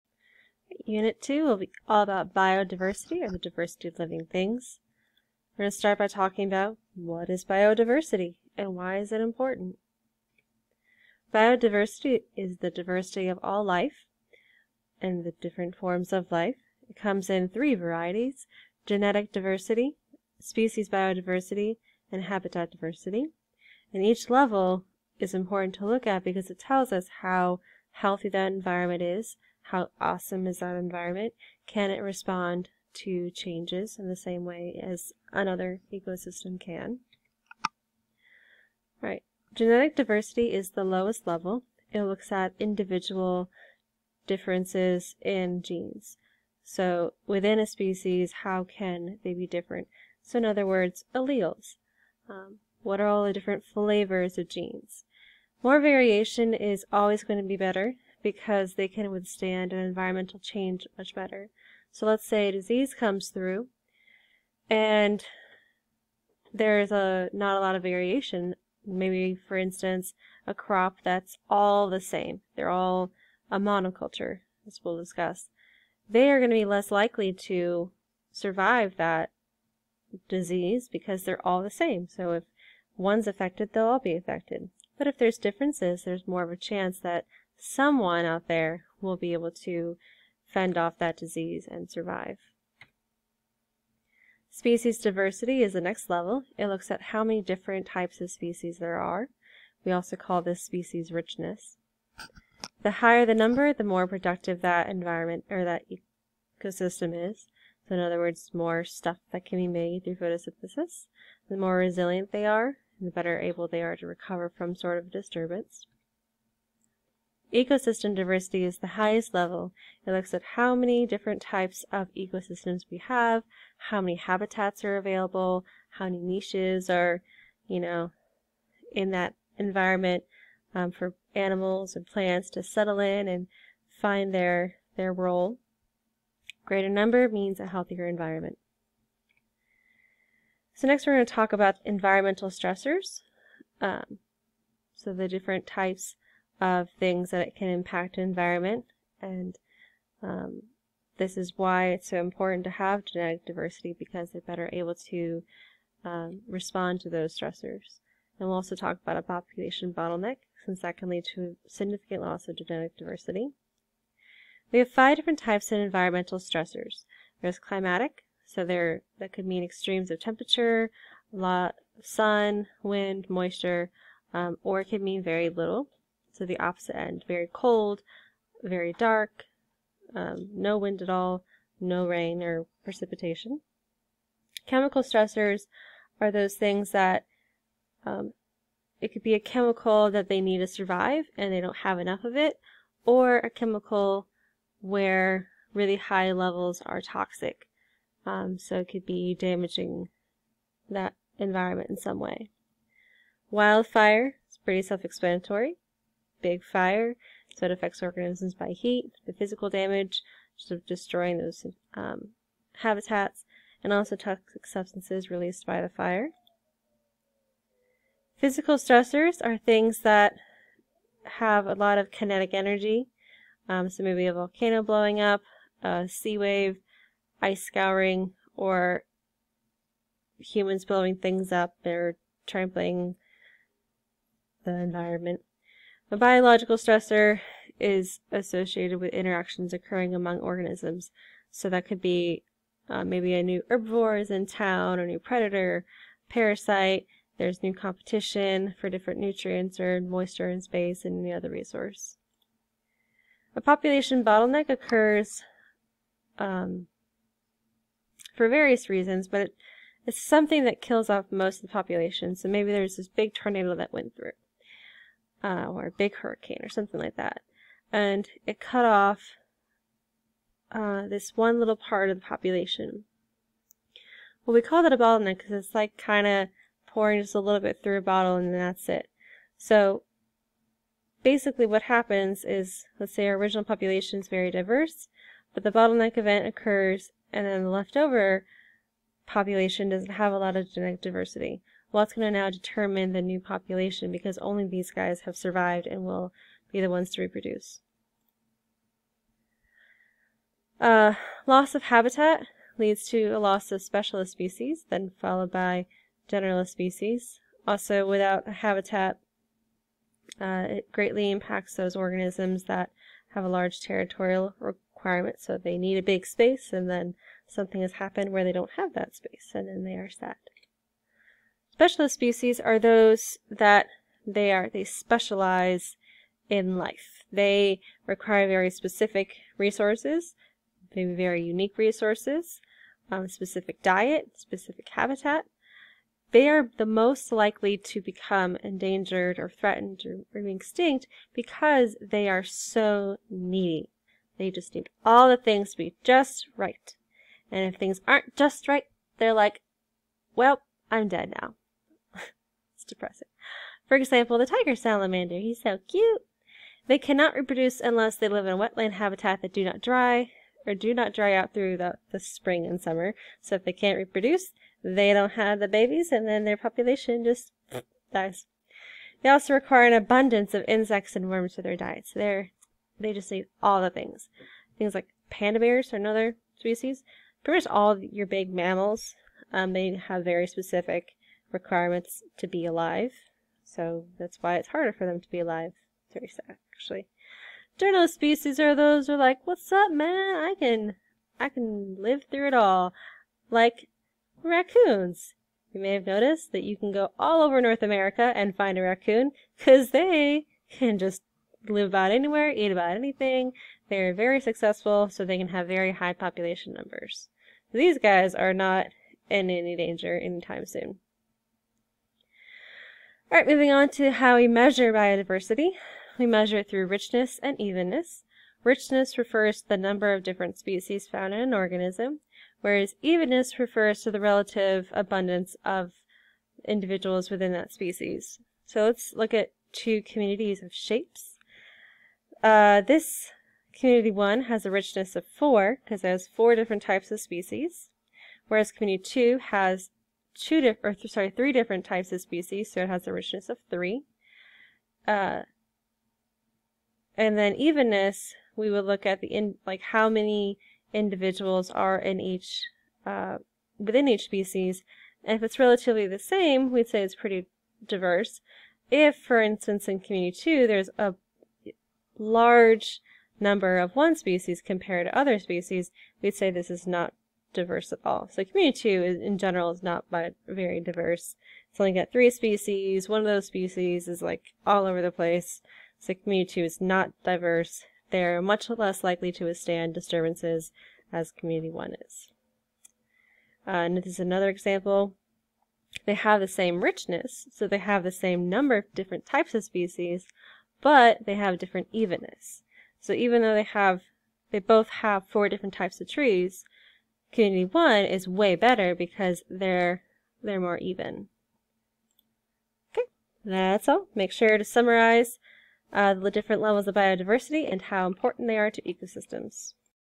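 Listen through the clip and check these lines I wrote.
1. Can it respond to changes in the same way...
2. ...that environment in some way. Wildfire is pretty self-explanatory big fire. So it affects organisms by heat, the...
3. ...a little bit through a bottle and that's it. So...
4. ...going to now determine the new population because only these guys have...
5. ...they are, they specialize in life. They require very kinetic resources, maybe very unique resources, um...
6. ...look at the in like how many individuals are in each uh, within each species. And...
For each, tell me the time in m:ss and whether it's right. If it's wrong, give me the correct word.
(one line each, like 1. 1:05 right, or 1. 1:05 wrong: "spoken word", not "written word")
1. 0:31 right
2. 3:20 right
3. 4:37 right
4. 4:52 right
5. 5:24 wrong: "specific", not "kinetic"
6. 7:28 right.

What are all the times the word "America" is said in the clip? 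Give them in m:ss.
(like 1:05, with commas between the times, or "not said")
6:37.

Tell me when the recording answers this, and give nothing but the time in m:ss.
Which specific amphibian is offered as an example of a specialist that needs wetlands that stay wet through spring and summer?
5:54.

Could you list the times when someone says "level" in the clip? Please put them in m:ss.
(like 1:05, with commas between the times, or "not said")
0:24, 0:41, 1:36, 1:59, 3:16, 8:26.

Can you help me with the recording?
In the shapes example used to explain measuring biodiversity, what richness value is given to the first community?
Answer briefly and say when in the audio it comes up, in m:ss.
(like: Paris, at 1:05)
4, at 7:15.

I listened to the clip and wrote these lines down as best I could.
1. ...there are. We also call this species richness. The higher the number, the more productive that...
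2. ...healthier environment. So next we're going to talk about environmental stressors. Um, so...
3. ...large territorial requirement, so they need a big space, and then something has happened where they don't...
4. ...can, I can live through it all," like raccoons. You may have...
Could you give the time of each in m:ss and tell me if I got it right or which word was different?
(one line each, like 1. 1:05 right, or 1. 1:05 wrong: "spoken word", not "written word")
1. 1:38 right
2. 2:17 right
3. 5:13 right
4. 6:30 right.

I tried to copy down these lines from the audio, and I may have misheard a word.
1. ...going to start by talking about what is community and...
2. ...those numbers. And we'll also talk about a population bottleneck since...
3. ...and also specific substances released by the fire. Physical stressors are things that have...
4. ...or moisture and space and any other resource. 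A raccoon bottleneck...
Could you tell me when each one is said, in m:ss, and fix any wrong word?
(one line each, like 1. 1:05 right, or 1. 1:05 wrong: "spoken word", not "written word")
1. 0:05 wrong: "biodiversity", not "community"
2. 2:37 wrong: "stressors", not "numbers"
3. 3:33 wrong: "toxic", not "specific"
4. 4:09 wrong: "population", not "raccoon".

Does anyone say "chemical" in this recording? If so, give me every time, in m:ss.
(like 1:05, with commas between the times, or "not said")
3:04, 3:09, 3:13.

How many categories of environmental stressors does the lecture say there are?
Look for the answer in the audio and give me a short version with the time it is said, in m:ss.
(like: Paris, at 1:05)
5, at 2:44.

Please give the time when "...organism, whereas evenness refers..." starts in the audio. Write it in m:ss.
7:01.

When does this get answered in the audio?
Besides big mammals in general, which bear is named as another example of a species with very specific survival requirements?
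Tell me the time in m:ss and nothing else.
6:15.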